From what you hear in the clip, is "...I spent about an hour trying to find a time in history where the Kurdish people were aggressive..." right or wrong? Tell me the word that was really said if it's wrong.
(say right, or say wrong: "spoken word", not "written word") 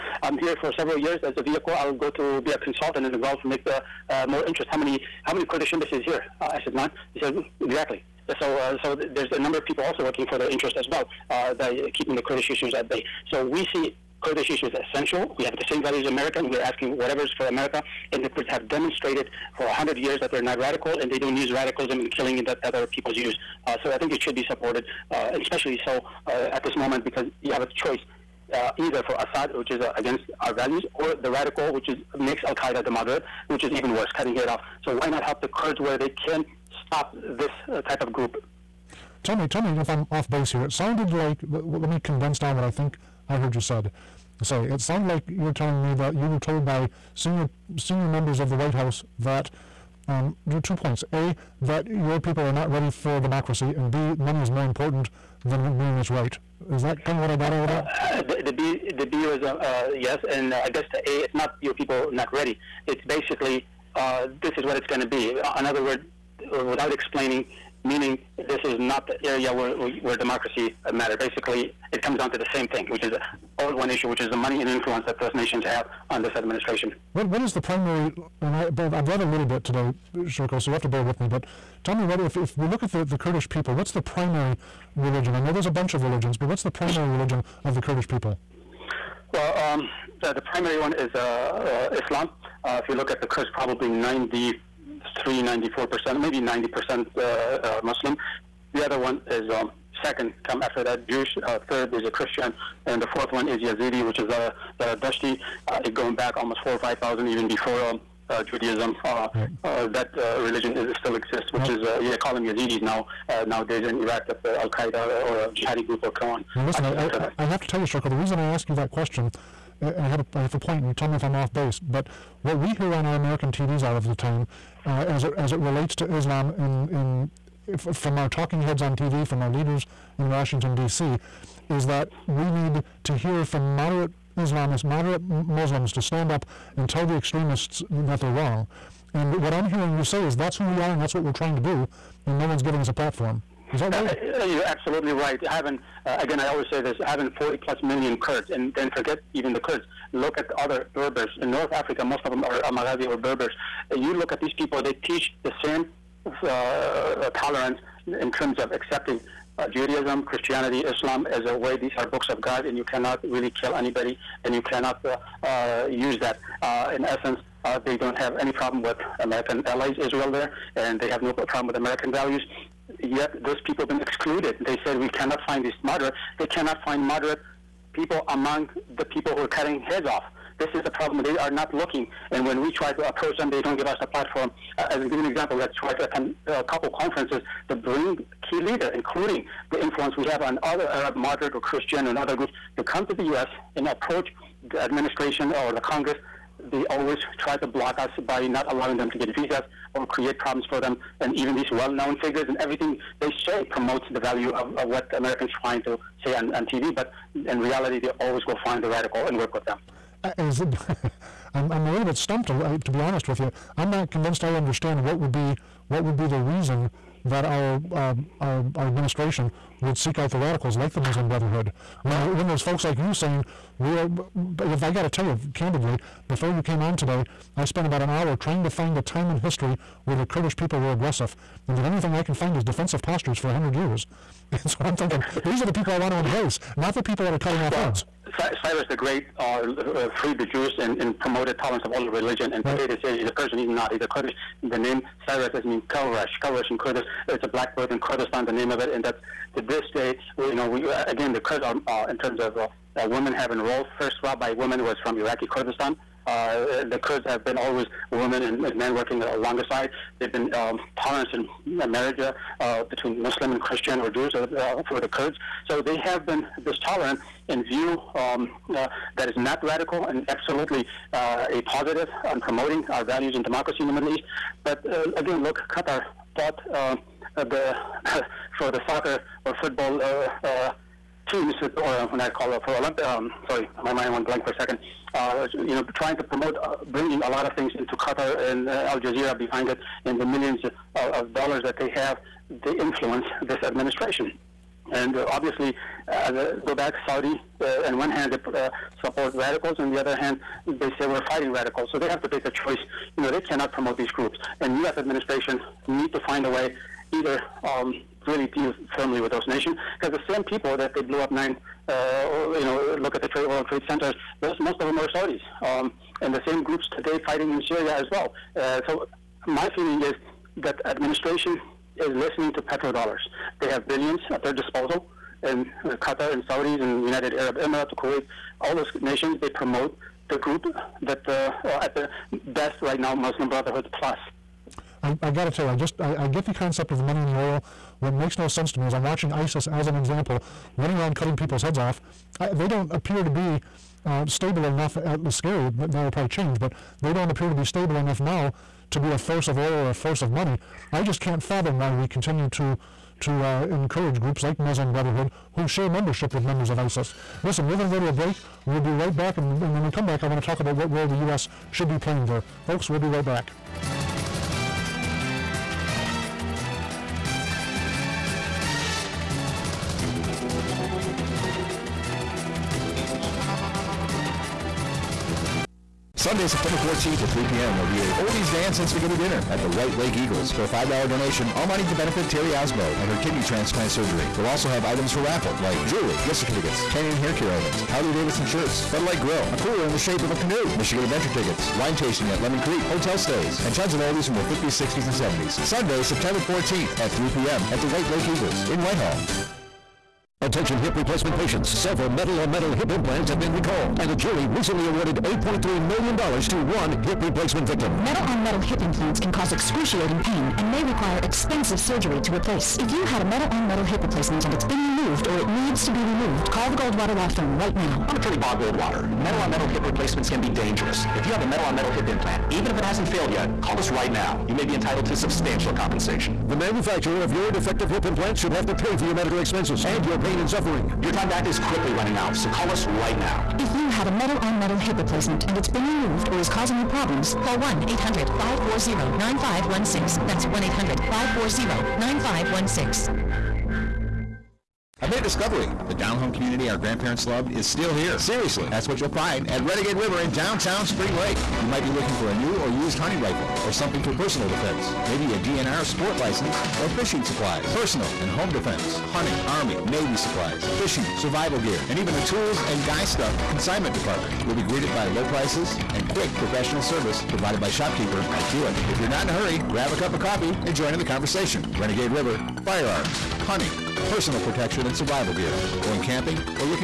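right.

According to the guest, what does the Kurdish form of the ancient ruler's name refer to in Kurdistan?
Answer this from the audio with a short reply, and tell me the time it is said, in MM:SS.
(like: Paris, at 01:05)
a blackbird, at 04:07.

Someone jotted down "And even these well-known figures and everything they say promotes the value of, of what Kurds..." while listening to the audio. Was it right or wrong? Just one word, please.
wrong.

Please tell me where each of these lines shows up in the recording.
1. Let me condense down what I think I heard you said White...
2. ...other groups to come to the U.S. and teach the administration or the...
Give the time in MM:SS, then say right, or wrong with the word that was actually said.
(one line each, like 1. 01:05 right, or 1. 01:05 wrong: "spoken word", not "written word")
1. 00:41 wrong: "Sorry", not "White"
2. 03:12 wrong: "approach", not "teach".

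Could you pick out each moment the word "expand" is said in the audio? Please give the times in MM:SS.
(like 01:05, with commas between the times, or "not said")
not said.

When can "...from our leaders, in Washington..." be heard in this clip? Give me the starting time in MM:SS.
02:09.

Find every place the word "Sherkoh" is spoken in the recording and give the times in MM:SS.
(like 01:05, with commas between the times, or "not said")
01:20, 01:57.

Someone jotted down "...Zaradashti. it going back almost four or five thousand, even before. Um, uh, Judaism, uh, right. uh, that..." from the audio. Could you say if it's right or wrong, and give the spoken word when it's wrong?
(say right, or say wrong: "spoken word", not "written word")
right.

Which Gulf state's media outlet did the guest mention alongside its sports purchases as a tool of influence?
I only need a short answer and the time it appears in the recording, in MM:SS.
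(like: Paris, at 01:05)
Al Jazeera, at 04:48.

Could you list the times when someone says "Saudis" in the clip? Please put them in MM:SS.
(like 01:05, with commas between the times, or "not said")
04:57, 05:15, 05:26.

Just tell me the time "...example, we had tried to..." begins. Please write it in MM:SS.
03:05.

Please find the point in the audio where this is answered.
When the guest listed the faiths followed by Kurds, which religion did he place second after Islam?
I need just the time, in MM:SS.
01:41.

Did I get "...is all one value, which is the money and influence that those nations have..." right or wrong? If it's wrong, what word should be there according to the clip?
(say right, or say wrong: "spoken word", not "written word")
wrong: "issue", not "value".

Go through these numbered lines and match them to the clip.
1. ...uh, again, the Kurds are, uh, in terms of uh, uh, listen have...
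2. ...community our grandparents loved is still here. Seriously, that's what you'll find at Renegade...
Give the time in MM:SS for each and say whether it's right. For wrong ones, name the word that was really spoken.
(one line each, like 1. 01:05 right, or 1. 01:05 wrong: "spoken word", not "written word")
1. 04:10 wrong: "women", not "listen"
2. 07:26 right.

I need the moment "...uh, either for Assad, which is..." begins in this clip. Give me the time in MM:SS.
00:28.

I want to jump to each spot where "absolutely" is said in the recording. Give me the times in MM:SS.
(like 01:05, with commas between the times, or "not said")
02:24, 04:30.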